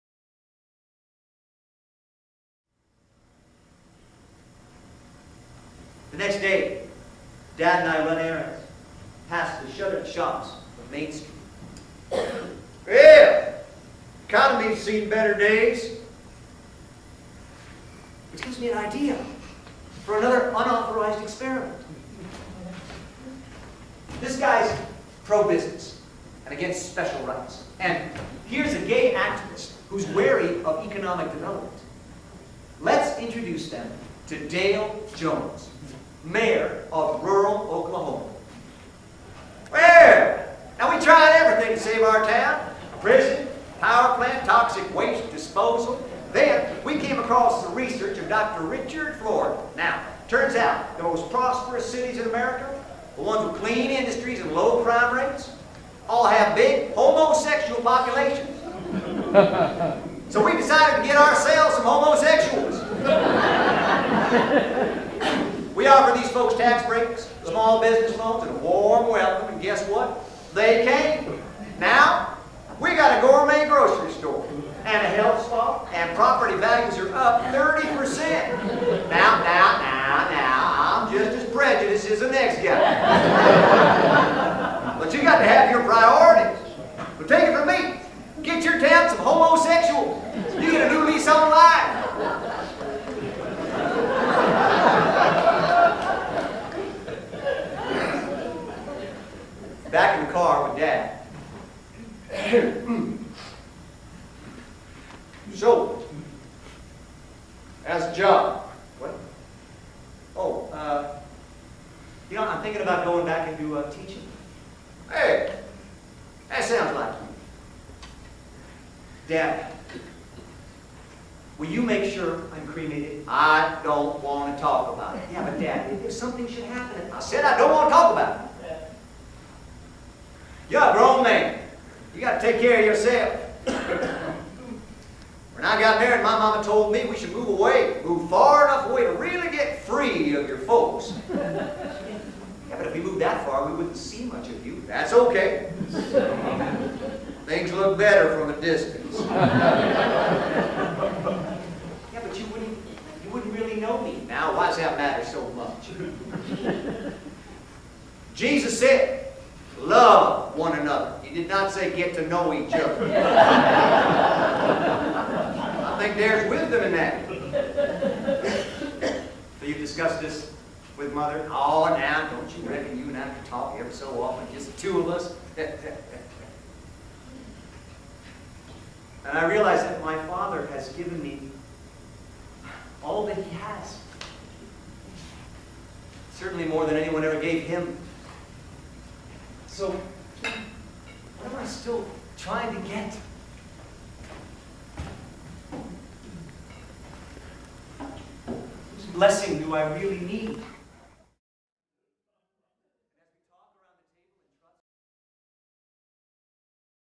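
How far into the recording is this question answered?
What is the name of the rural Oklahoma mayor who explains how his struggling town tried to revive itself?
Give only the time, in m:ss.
0:34.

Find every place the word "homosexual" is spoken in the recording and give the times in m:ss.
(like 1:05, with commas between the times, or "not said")
0:56, 1:01.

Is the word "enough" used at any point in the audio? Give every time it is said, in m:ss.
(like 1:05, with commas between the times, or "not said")
2:18.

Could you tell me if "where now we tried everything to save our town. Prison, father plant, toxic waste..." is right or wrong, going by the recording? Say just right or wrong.
wrong.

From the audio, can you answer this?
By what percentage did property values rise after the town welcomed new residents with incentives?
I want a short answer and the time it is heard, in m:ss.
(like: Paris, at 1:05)
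30%, at 1:17.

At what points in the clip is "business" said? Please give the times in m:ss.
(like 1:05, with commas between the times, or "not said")
0:25, 1:07.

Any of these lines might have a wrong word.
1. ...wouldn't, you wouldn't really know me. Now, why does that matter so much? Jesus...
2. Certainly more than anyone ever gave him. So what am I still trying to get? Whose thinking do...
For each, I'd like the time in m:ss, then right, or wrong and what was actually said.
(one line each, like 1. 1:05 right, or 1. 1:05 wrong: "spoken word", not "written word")
1. 2:32 right
2. 3:06 wrong: "blessing", not "thinking".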